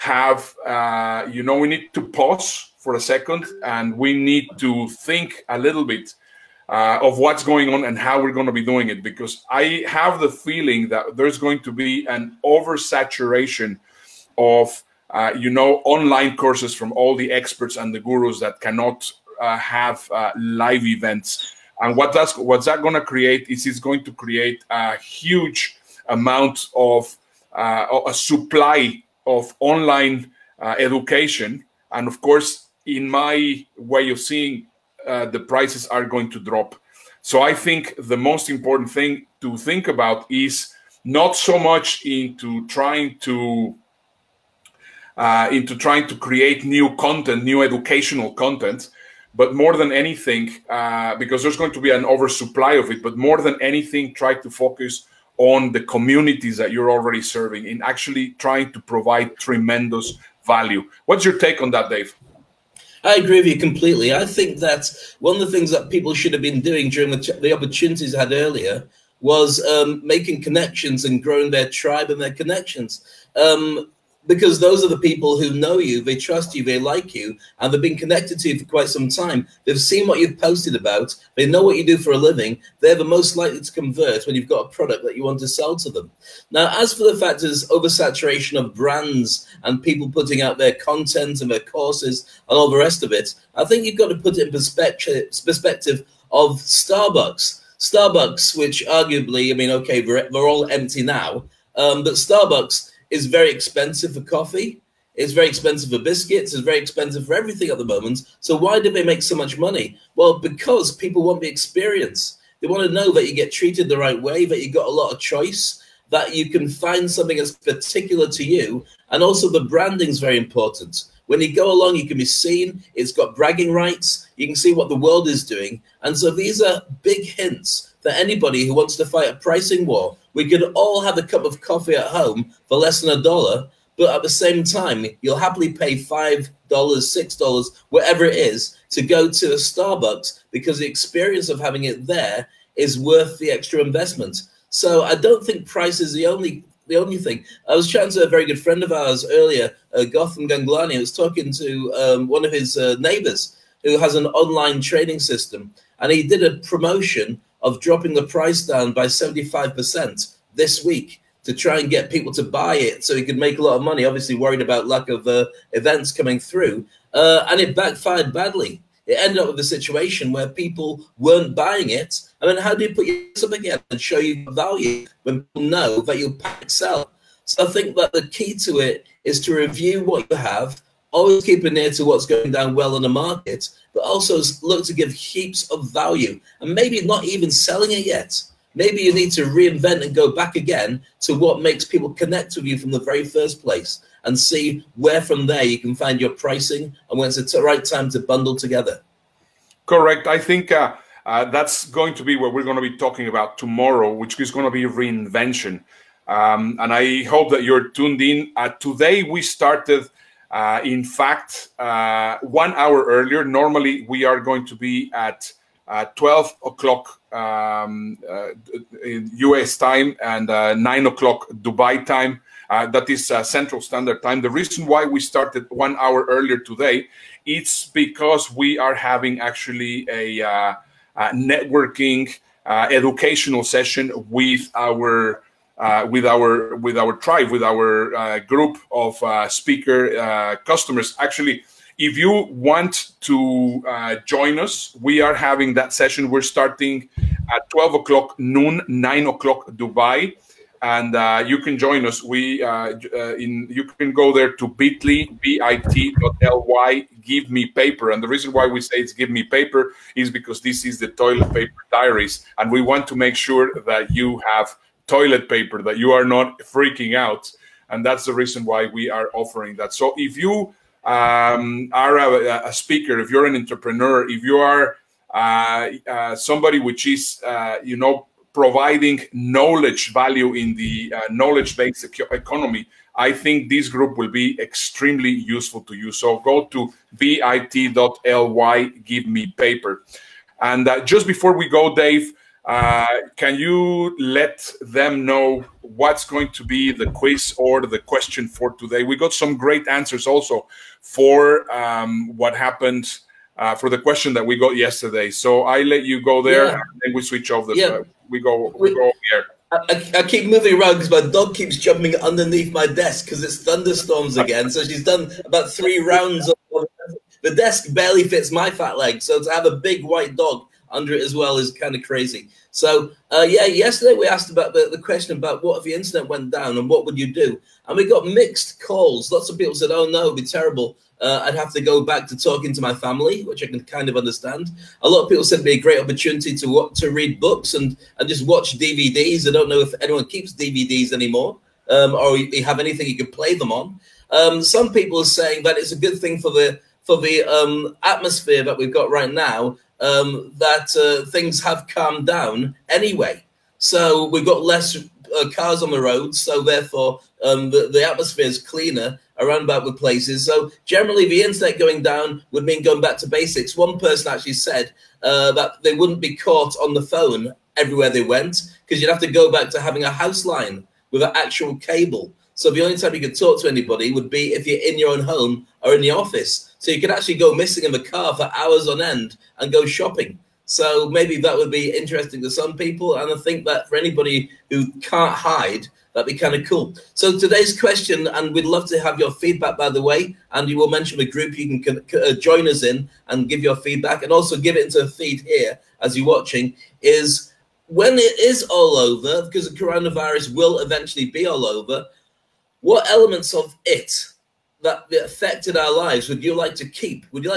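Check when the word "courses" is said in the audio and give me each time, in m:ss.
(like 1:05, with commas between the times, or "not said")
0:16, 0:32, 1:31.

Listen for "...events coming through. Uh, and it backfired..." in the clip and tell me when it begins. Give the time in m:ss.
2:45.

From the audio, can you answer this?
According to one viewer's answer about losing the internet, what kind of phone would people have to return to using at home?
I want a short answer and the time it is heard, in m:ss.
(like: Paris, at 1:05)
A house line, at 6:10.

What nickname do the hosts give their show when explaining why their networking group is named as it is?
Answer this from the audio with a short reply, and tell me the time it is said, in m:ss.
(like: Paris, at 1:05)
The toilet paper diaries, at 4:21.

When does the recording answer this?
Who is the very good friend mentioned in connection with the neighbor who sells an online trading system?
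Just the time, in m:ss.
2:30.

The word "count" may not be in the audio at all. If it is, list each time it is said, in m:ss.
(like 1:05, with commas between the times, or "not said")
not said.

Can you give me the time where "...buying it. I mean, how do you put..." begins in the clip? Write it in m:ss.
2:51.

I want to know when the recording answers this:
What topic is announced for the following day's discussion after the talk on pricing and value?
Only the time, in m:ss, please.
3:24.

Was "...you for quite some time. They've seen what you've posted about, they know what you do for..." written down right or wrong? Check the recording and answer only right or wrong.
right.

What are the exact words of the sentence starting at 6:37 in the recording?
Is when it is all over, because the coronavirus will eventually be all over.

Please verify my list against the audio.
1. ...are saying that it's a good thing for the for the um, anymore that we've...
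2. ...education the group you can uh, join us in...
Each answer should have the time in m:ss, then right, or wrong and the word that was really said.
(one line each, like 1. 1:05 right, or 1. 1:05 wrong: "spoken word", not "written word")
1. 5:45 wrong: "atmosphere", not "anymore"
2. 6:30 wrong: "mention", not "education".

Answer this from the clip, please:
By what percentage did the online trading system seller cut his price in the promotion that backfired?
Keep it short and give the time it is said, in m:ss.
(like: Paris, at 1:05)
75%, at 2:39.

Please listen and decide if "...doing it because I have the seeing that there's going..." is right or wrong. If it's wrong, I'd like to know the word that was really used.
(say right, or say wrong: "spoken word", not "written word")
wrong: "feeling", not "seeing".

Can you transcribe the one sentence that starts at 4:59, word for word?
We got some great answers also for um, what happened uh, for the question that we got yesterday.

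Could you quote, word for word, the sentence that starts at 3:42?
Uh, that is Central Standard Time.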